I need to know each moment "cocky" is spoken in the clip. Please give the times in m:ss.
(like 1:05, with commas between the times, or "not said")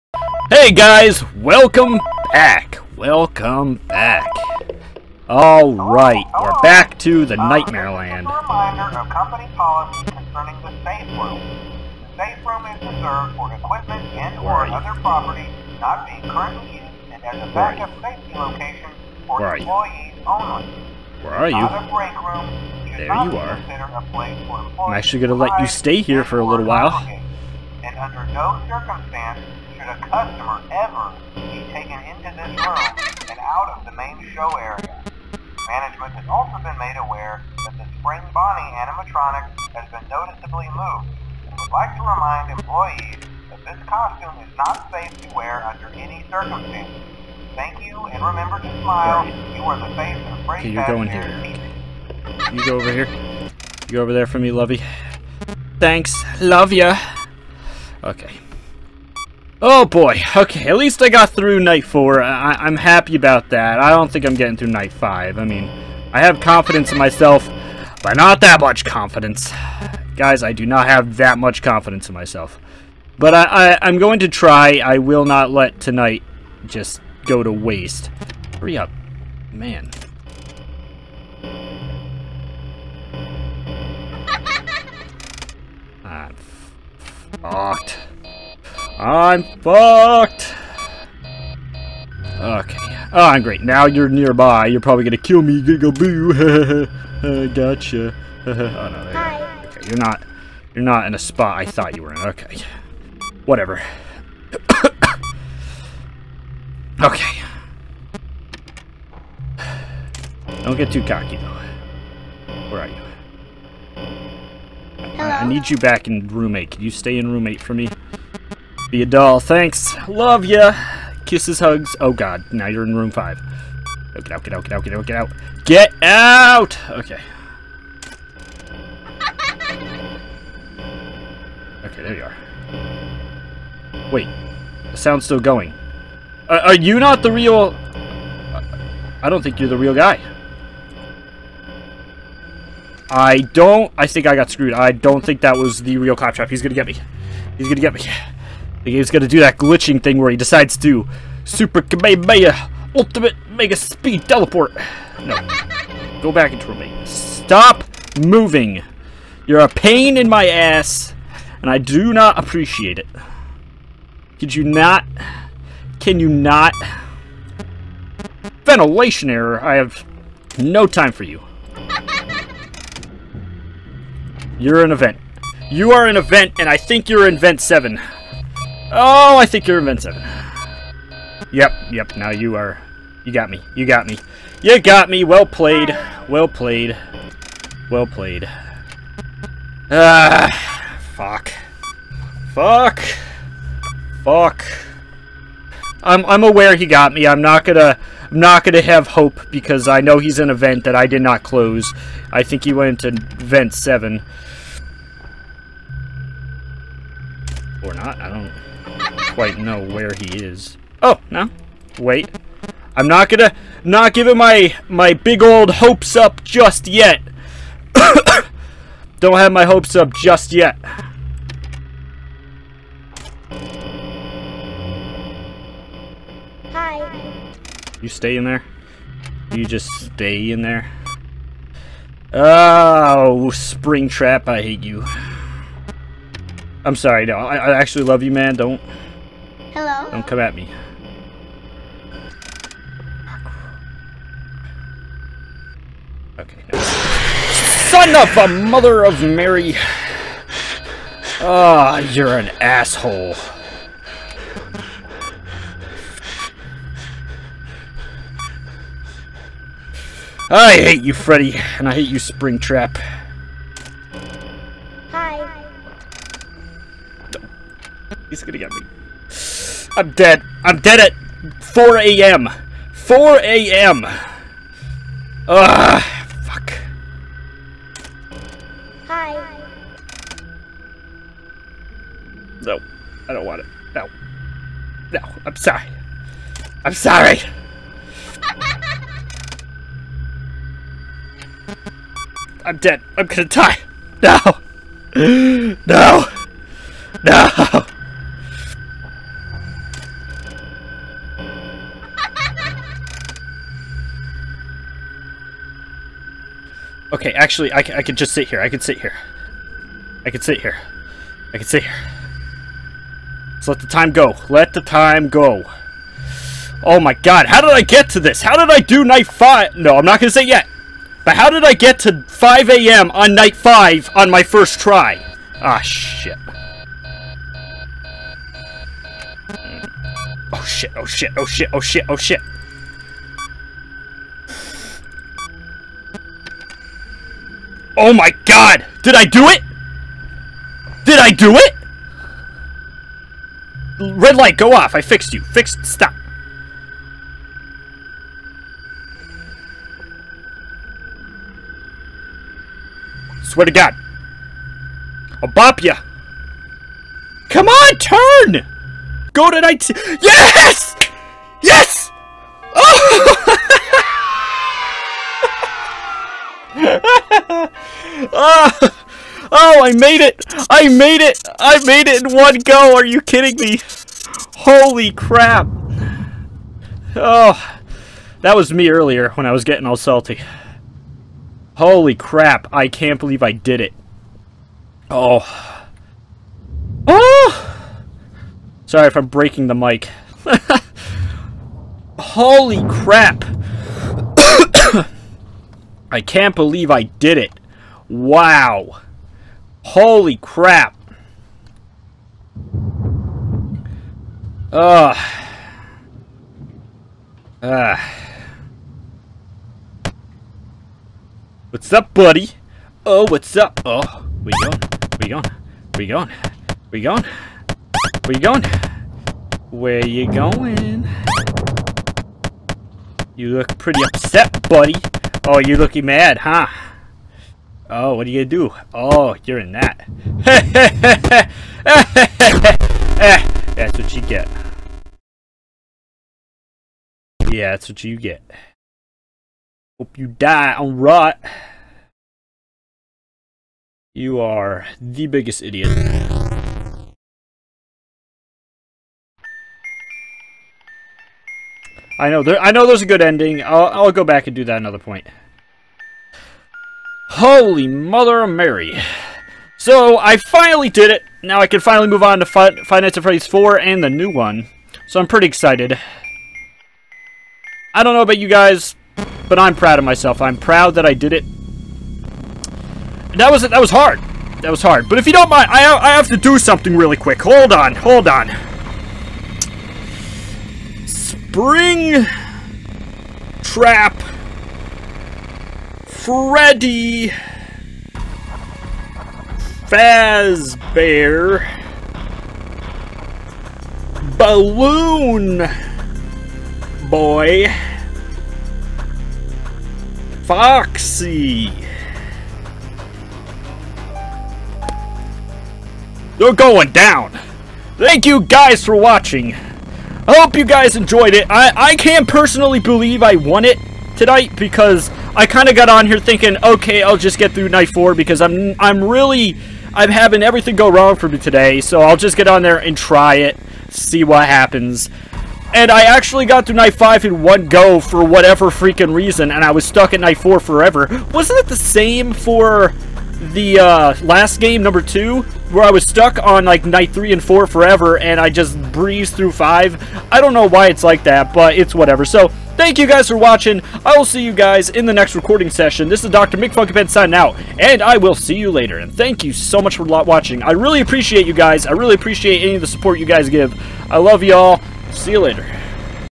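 1:51.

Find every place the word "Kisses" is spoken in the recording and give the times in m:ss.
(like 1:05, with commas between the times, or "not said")
2:01.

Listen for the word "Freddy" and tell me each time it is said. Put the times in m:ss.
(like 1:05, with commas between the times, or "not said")
4:21, 7:43, 8:06.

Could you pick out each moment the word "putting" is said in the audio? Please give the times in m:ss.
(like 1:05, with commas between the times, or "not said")
not said.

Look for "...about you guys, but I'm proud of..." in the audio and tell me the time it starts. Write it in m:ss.
7:48.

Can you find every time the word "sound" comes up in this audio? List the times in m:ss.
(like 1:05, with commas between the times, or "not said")
2:14.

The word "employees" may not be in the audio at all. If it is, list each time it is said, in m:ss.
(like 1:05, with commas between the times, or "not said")
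0:19, 0:42.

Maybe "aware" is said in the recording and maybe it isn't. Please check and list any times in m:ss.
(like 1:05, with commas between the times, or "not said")
0:36, 3:16.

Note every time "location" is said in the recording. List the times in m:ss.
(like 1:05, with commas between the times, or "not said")
0:18.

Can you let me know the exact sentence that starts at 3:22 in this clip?
I think he went to event 7.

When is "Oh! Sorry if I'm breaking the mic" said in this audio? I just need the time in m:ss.
6:27.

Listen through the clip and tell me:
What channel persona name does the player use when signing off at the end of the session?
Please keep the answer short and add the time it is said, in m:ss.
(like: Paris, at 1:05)
Dr. McFunkyPants, at 9:06.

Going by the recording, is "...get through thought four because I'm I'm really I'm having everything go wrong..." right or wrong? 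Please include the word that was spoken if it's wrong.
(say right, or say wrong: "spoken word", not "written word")
wrong: "night", not "thought".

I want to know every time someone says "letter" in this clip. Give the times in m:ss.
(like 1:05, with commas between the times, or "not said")
not said.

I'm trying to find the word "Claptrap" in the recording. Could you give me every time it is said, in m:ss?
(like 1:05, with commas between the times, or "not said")
2:26.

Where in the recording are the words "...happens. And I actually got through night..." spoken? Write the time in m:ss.
8:44.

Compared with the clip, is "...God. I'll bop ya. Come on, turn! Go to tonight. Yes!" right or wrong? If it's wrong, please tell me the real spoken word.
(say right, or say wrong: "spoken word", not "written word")
wrong: "night", not "tonight".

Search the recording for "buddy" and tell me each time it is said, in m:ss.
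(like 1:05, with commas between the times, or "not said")
6:52, 7:04.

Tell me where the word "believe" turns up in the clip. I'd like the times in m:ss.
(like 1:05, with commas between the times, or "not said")
6:23, 6:36, 8:32.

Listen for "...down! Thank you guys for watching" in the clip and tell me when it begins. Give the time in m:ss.
8:26.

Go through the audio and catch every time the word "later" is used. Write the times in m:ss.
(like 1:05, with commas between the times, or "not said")
9:08, 9:15.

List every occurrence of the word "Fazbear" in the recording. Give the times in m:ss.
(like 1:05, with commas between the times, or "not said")
8:09.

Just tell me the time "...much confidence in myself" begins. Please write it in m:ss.
1:11.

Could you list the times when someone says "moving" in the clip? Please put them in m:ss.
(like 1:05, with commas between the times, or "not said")
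2:38.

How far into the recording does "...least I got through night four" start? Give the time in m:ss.
1:00.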